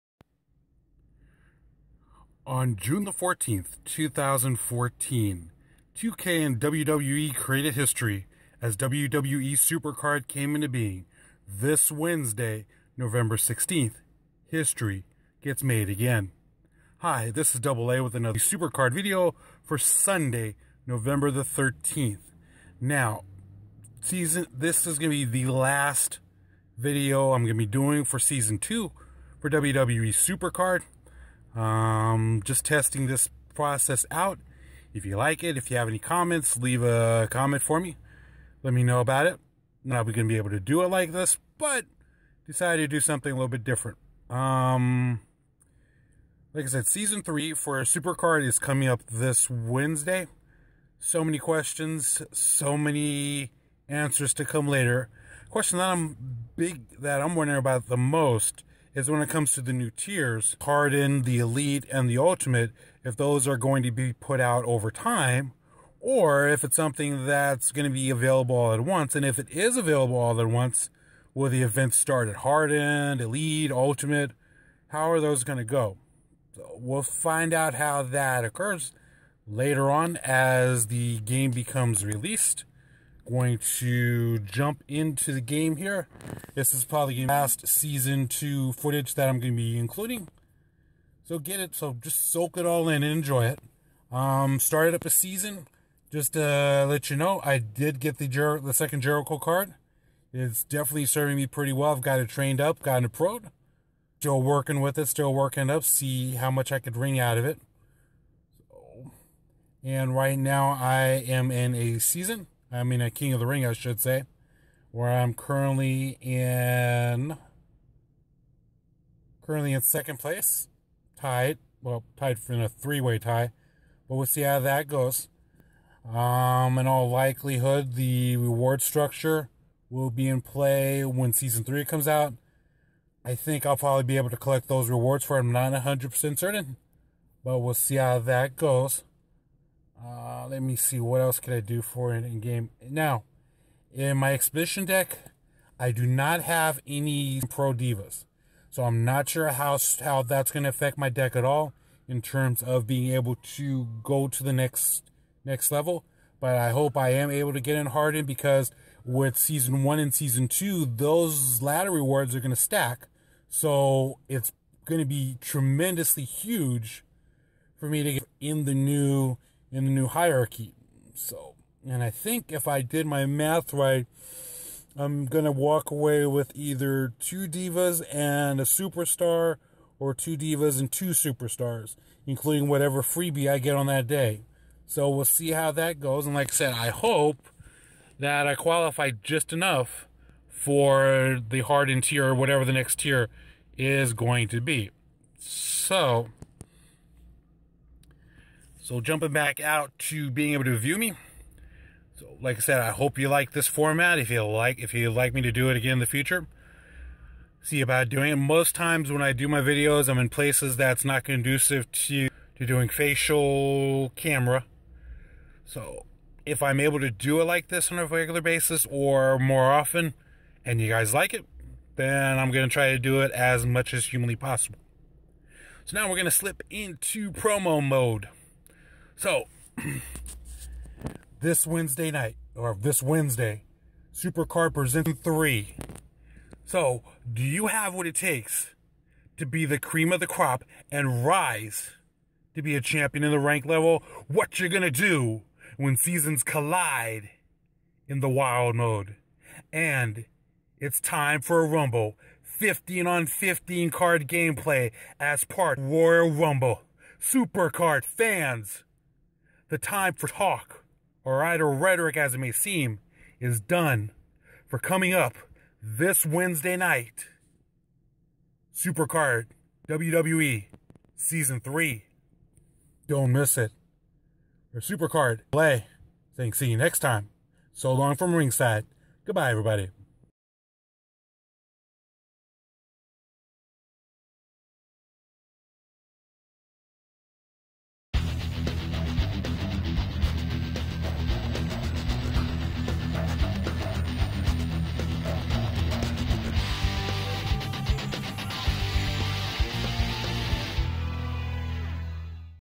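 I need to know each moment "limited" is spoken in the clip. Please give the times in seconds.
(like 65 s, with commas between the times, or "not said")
not said.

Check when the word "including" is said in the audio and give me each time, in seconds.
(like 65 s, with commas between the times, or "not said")
89 s, 182 s.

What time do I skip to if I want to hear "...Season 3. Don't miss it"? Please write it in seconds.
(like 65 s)
271 s.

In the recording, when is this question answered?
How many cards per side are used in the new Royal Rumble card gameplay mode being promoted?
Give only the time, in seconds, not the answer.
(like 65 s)
252 s.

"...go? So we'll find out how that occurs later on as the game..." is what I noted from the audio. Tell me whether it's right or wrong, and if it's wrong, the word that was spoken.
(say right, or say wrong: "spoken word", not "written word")
right.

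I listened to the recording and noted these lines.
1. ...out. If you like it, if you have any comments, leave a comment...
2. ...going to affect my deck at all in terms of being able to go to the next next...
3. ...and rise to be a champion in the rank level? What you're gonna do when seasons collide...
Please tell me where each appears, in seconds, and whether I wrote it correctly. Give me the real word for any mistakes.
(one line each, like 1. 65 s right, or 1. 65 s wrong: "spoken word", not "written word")
1. 34 s right
2. 150 s right
3. 240 s right.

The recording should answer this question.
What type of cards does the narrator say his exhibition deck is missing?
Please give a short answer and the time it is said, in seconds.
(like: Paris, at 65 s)
Pro divas, at 147 s.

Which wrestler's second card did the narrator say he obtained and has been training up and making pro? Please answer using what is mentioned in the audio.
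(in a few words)
Jericho.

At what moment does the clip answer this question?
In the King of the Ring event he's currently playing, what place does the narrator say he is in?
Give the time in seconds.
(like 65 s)
119 s.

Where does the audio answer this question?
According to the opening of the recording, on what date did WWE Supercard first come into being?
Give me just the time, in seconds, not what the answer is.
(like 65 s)
2 s.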